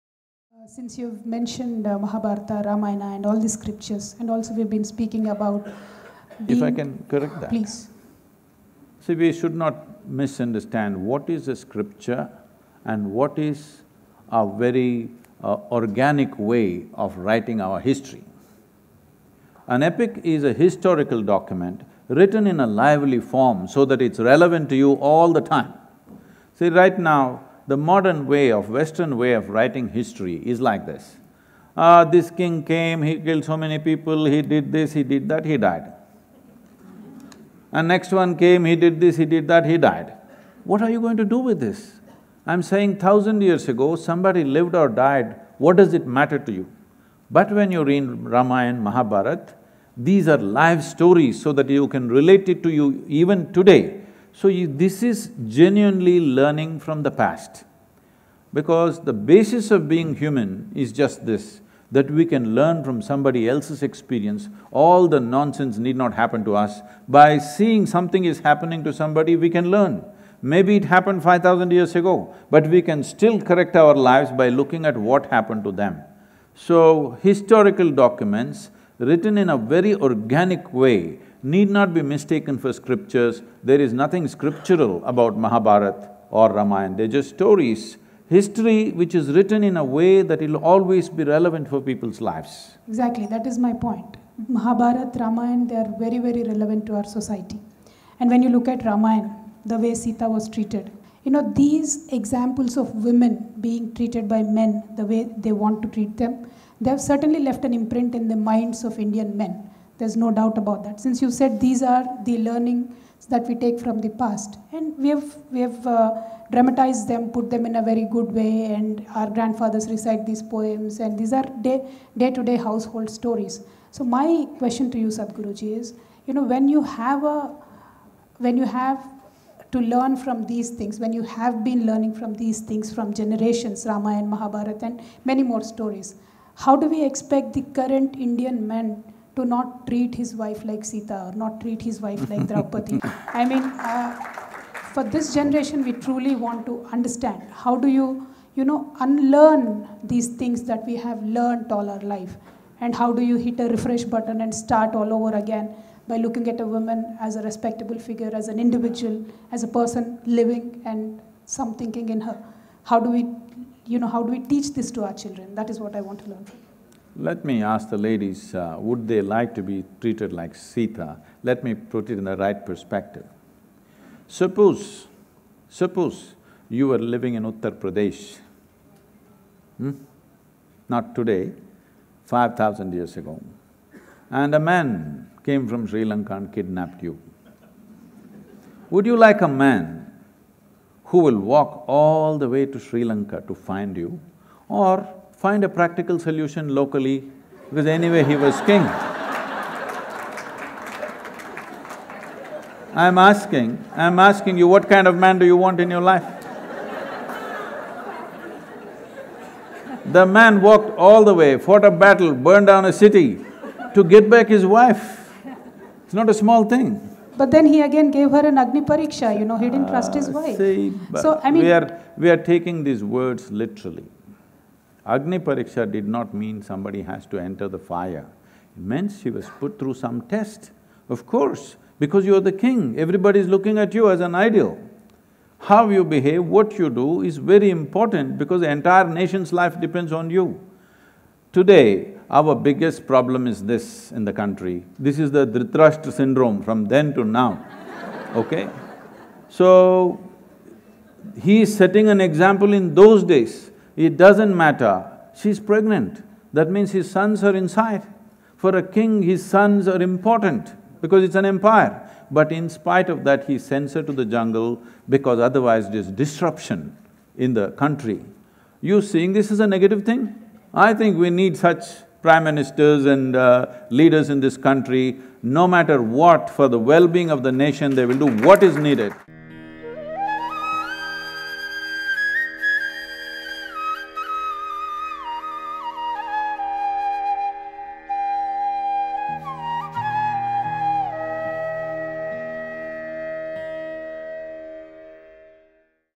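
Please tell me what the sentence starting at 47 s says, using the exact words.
But when you read Ramayana, Mahabharata, these are live stories so that you can relate it to you even today.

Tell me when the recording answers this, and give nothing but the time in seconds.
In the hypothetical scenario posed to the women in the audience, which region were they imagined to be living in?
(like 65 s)
177 s.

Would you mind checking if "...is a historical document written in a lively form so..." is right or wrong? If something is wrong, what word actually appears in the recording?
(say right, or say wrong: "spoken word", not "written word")
right.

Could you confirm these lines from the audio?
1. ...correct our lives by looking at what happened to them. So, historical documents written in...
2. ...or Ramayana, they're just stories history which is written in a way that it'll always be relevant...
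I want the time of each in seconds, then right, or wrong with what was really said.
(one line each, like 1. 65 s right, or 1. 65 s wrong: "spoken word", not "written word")
1. 73 s right
2. 86 s right.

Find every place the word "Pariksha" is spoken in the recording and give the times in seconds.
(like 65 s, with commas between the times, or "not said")
218 s, 225 s.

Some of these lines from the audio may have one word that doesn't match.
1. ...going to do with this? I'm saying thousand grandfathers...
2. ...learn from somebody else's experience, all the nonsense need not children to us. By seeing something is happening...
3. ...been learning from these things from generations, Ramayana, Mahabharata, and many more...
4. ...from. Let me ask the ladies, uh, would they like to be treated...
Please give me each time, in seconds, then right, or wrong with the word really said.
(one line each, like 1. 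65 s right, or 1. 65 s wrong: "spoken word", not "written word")
1. 40 s wrong: "years", not "grandfathers"
2. 62 s wrong: "happen", not "children"
3. 131 s right
4. 166 s right.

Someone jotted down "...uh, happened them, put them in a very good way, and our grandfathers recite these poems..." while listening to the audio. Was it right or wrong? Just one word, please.
wrong.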